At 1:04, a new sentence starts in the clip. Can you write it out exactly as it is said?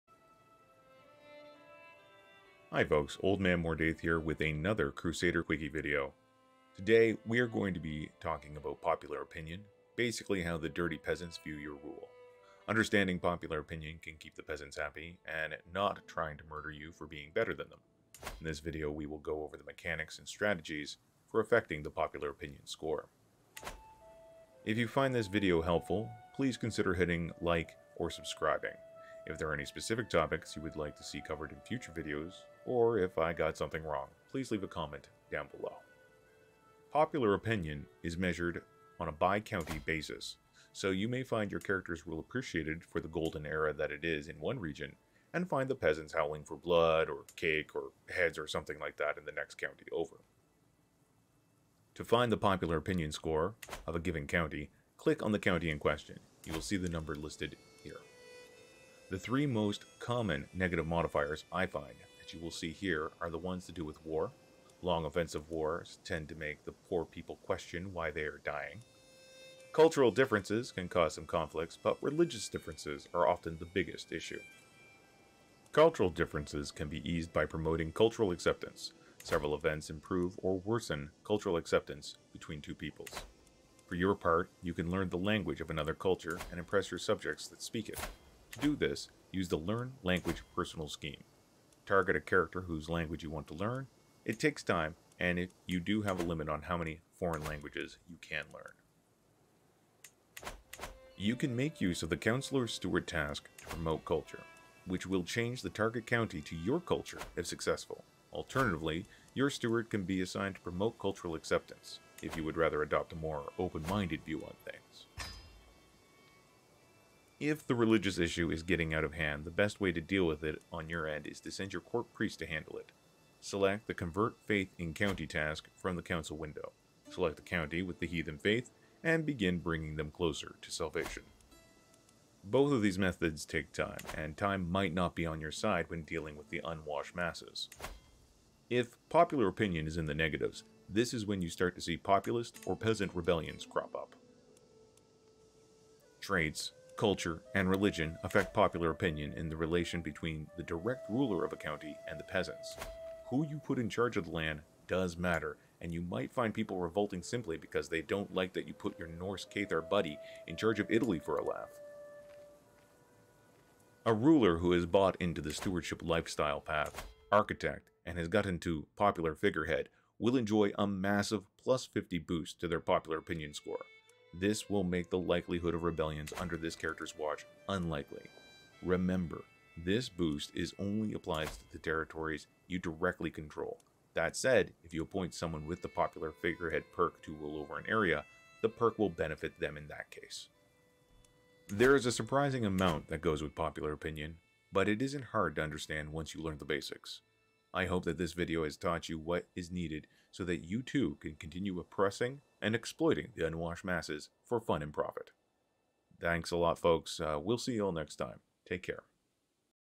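Long offensive wars tend to make the poor people question why they are dying.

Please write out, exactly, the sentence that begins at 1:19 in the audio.
Several events improve or worsen cultural acceptance between two peoples.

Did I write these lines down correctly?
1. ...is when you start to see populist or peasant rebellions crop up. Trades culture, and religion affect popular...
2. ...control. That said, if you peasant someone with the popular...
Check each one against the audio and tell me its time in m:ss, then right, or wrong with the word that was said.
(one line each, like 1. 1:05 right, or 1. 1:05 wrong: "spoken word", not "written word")
1. 2:21 right
2. 3:03 wrong: "appoint", not "peasant".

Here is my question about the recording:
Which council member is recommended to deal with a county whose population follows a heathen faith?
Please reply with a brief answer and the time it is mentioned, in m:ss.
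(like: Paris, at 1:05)
court priest, at 2:01.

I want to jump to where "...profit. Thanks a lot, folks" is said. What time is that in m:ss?
3:24.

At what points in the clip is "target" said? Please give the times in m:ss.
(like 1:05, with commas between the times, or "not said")
1:31, 1:45.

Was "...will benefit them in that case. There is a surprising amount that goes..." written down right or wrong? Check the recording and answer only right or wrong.
right.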